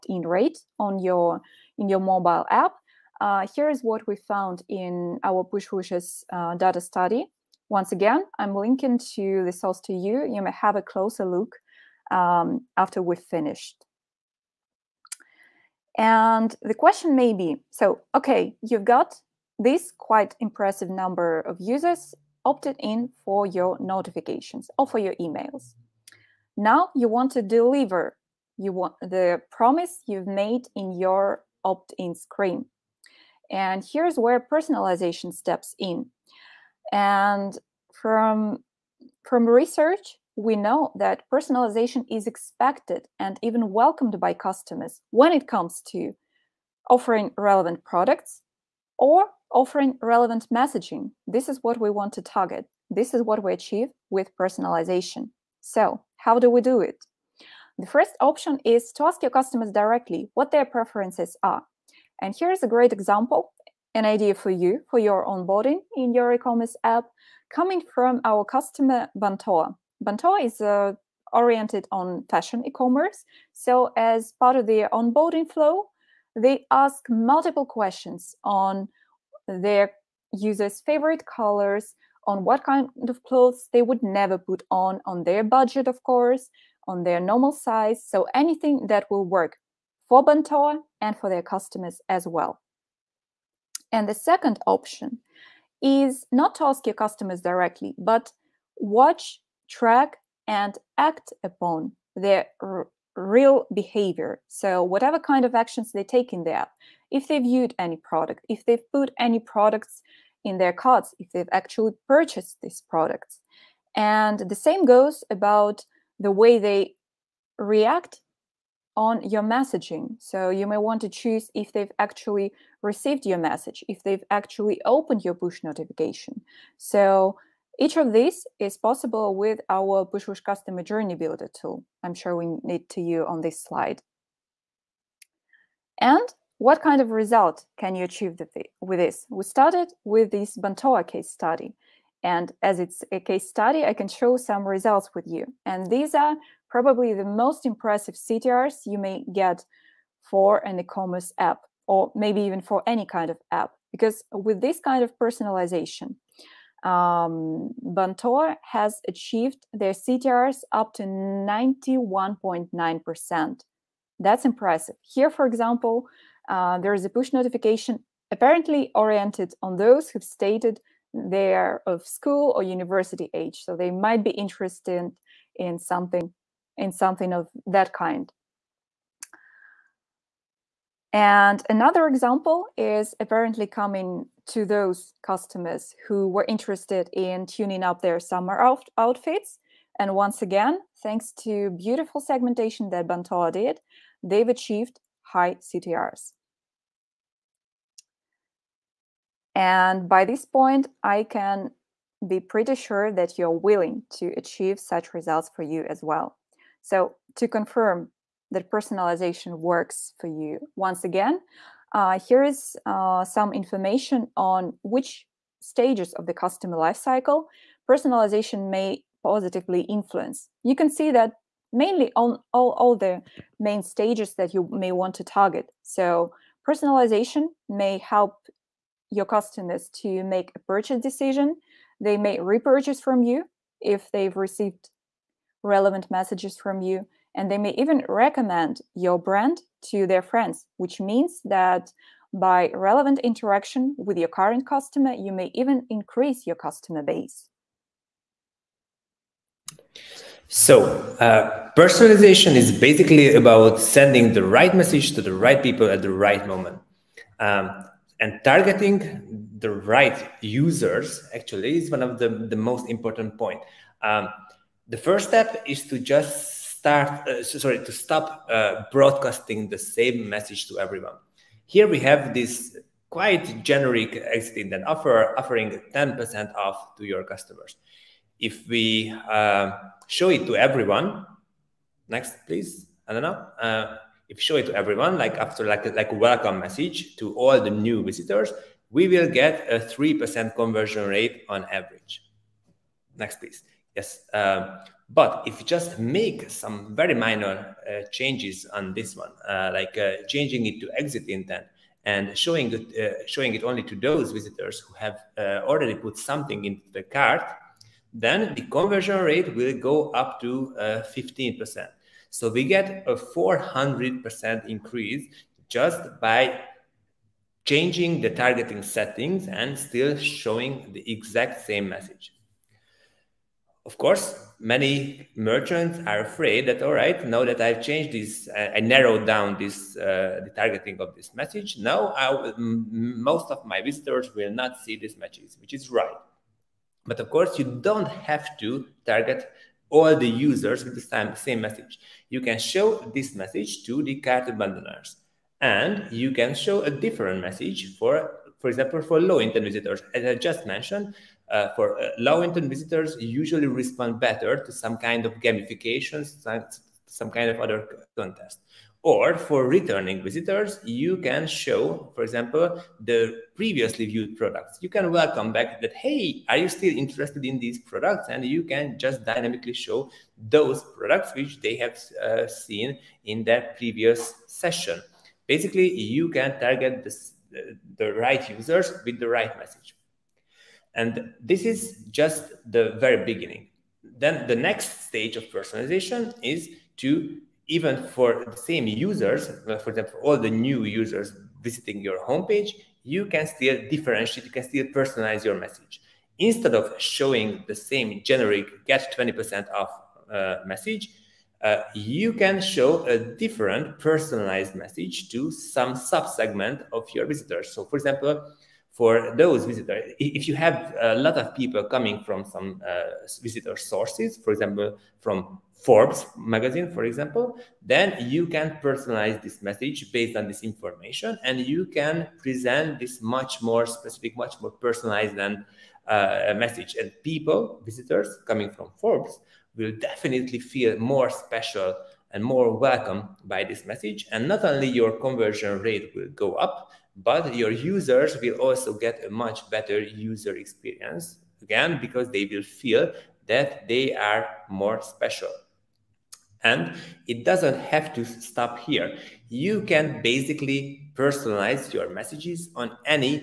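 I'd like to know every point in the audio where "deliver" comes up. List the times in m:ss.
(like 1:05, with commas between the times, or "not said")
0:27.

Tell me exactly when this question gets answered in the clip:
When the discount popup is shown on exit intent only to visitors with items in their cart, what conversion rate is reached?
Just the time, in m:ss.
5:10.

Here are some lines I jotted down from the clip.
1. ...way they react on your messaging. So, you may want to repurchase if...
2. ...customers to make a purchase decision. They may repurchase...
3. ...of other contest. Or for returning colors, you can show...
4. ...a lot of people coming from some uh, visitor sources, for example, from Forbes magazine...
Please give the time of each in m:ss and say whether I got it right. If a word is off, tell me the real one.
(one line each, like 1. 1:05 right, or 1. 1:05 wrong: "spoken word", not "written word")
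1. 1:56 wrong: "choose", not "repurchase"
2. 3:49 right
3. 5:57 wrong: "visitors", not "colors"
4. 6:51 right.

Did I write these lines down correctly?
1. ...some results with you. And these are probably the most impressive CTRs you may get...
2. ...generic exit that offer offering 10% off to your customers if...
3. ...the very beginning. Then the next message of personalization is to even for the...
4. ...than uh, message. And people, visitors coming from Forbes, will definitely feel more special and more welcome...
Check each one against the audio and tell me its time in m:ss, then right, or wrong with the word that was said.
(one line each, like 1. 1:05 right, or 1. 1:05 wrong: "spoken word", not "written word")
1. 2:24 right
2. 4:33 right
3. 6:22 wrong: "stage", not "message"
4. 7:05 right.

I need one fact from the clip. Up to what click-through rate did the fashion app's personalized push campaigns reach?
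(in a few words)
91.9%.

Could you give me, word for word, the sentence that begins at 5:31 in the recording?
Now, most of my visitors will not see these matches, which is right.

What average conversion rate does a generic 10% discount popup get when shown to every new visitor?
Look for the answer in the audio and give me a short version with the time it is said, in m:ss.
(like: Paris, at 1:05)
3%, at 4:49.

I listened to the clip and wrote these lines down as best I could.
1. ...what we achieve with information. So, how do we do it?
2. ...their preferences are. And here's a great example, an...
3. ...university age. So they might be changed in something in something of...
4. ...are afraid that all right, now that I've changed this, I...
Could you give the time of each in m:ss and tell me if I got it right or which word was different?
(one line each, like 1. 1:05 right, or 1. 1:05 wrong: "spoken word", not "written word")
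1. 0:53 wrong: "personalization", not "information"
2. 1:00 right
3. 2:52 wrong: "interested", not "changed"
4. 5:26 right.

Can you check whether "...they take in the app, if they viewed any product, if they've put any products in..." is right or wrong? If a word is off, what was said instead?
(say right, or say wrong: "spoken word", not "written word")
right.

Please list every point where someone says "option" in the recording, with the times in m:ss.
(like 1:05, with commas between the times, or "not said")
0:58, 1:34.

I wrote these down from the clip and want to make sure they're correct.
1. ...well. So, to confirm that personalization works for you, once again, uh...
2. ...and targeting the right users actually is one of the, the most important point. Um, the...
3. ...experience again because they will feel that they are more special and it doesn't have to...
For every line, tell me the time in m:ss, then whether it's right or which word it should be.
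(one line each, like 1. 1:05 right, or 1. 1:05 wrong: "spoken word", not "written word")
1. 3:26 right
2. 4:18 right
3. 7:20 right.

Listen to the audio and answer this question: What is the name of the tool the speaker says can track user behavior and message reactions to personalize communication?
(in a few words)
Pushwoosh Customer Journey Builder.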